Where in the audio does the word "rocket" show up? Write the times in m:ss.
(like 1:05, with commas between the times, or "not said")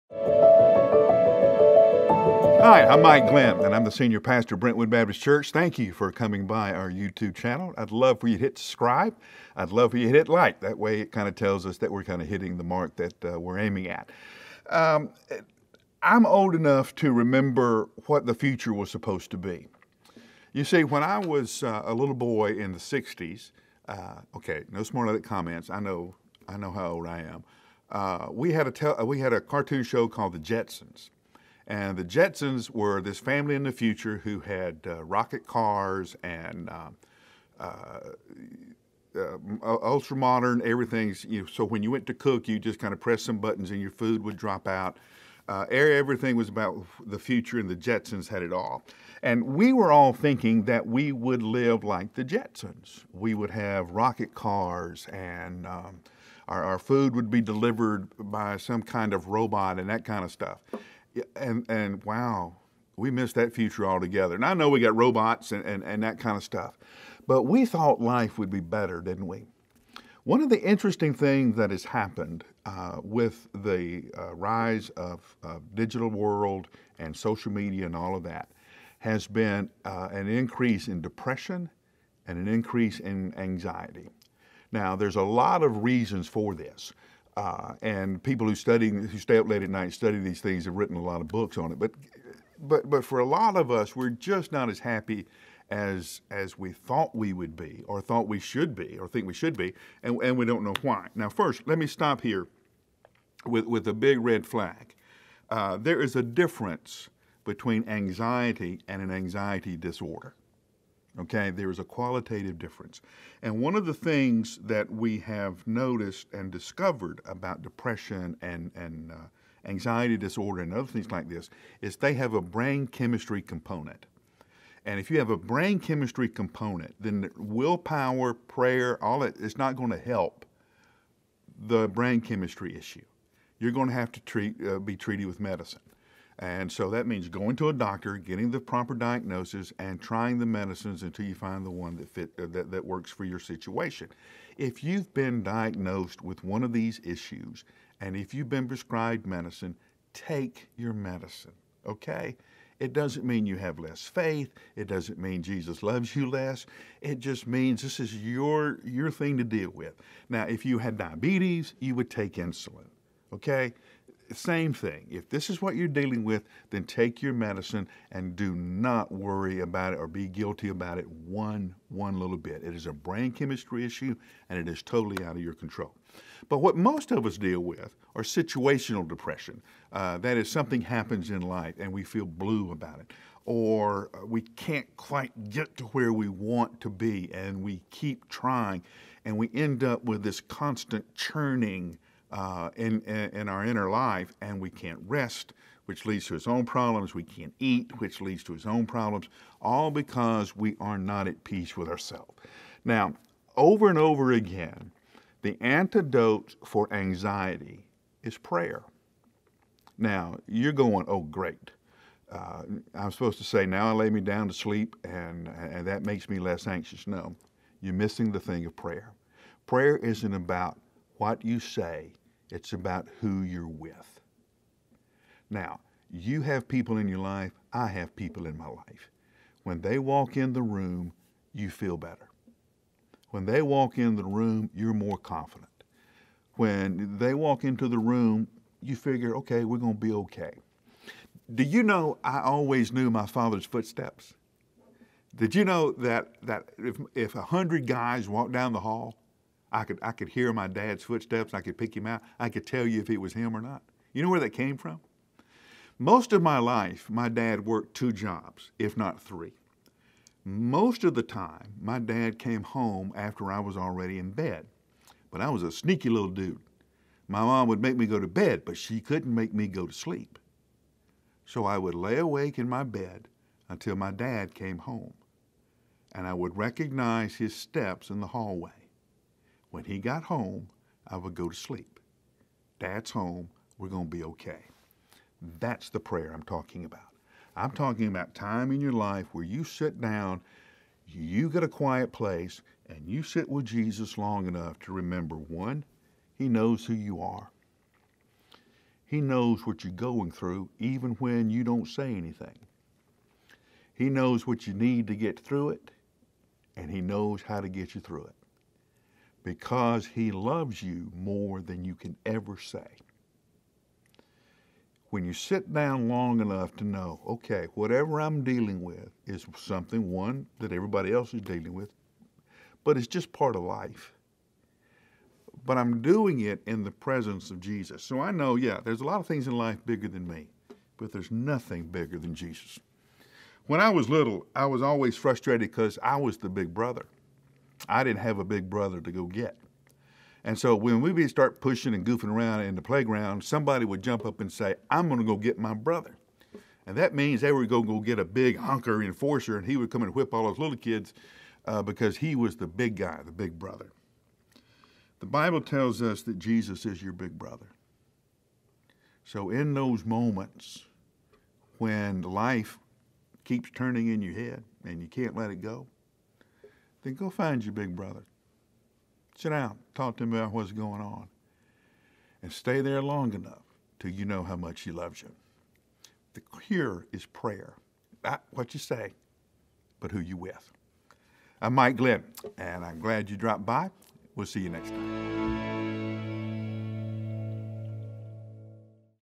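0:35, 0:53.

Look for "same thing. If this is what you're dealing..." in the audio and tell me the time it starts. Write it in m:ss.
2:44.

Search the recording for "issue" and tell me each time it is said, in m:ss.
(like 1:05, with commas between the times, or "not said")
2:12, 2:27, 2:53.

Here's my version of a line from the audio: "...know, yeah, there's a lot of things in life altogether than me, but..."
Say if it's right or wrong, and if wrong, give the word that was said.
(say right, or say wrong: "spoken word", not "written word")
wrong: "bigger", not "altogether".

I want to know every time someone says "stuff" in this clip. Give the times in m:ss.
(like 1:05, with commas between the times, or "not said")
1:00, 1:06.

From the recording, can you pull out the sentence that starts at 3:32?
Uh, I'm supposed to say, now I lay me down to sleep and, and that makes me less anxious.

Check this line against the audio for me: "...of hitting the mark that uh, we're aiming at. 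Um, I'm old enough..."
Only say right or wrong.
right.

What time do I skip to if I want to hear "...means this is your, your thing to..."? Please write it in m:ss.
2:37.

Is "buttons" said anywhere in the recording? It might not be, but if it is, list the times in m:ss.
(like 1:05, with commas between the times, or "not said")
0:43.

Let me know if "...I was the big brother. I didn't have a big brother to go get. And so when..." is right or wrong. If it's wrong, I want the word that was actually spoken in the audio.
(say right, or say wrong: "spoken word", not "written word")
right.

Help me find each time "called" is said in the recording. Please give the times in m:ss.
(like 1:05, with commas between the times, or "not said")
0:30.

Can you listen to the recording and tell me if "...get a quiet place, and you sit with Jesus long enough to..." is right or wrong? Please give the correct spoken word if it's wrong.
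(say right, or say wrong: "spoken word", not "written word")
right.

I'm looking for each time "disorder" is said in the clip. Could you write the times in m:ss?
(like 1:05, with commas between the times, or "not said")
1:49, 2:00.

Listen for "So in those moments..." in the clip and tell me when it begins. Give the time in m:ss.
5:59.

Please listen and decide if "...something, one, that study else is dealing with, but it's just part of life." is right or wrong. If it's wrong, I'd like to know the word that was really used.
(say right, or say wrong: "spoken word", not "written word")
wrong: "everybody", not "study".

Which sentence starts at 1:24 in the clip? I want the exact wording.
Now, there's a lot of reasons for this.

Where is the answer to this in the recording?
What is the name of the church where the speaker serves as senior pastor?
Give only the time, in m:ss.
0:04.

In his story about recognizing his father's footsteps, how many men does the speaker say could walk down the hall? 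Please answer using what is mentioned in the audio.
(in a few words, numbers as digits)
100.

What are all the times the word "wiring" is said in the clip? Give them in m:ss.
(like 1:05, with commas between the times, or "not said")
not said.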